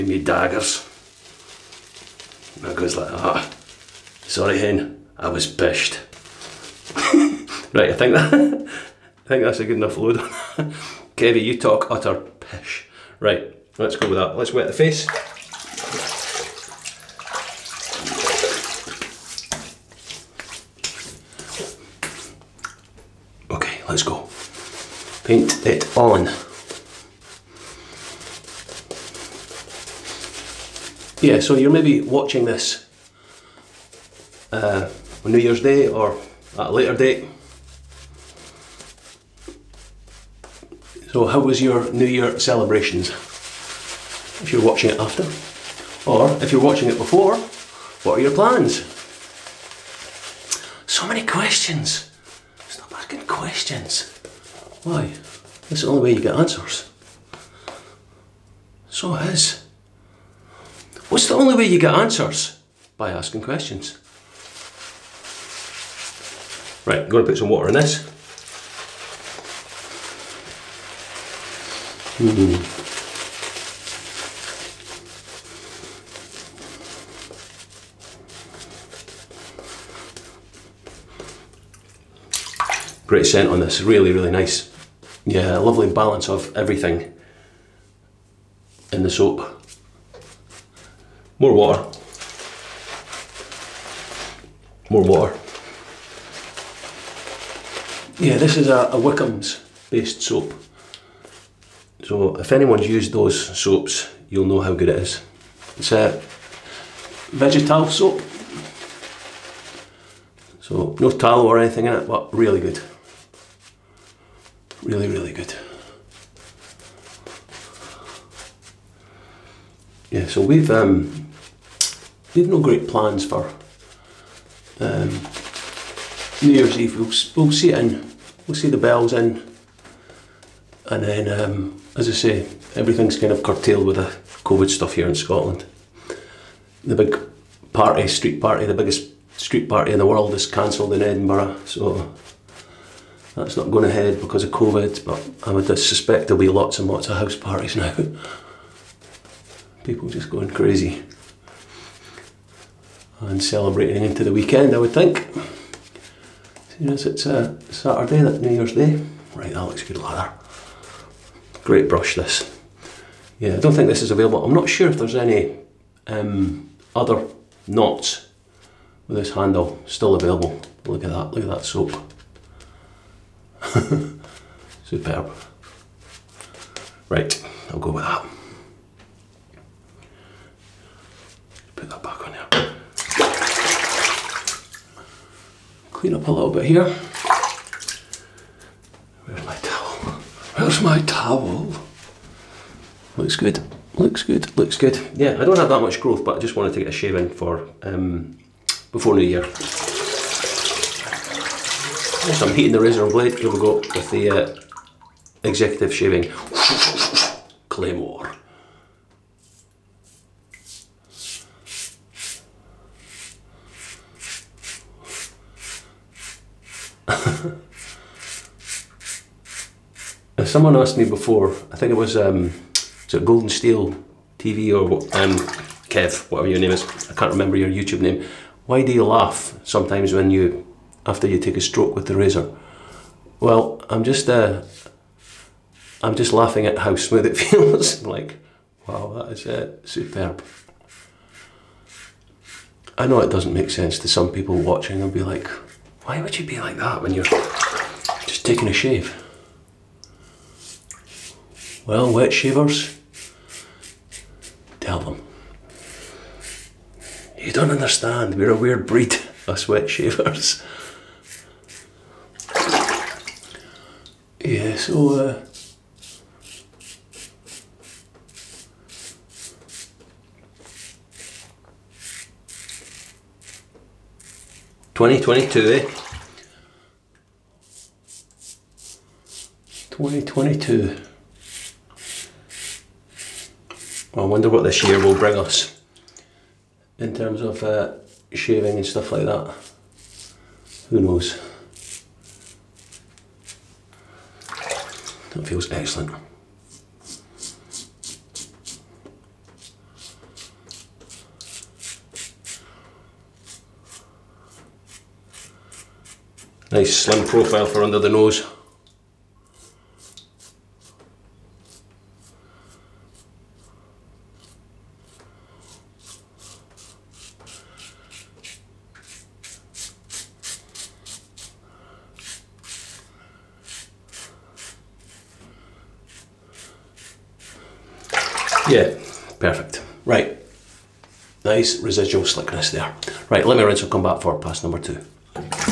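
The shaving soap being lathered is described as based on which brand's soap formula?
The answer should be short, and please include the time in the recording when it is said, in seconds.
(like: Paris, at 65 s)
Wickham's, at 98 s.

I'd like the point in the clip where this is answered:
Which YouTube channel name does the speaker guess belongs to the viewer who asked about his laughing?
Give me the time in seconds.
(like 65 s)
223 s.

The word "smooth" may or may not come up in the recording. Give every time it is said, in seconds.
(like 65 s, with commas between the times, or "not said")
236 s.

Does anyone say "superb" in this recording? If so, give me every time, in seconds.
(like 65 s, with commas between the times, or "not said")
174 s, 239 s.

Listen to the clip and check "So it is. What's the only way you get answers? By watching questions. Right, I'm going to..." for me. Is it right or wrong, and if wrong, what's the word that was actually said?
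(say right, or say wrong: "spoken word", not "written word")
wrong: "asking", not "watching".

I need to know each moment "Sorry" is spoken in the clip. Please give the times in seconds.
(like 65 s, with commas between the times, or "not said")
4 s.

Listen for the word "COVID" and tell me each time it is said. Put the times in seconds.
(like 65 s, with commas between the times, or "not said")
134 s, 144 s.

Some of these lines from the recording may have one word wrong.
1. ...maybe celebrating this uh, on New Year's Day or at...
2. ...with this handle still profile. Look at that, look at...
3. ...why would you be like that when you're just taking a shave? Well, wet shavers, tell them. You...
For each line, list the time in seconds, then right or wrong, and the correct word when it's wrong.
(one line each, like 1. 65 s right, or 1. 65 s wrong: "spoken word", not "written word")
1. 31 s wrong: "watching", not "celebrating"
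2. 169 s wrong: "available", not "profile"
3. 246 s right.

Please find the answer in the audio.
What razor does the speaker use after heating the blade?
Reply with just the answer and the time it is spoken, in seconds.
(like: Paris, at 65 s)
executive shaving claymore, at 205 s.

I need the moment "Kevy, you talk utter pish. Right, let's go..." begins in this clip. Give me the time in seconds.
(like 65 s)
11 s.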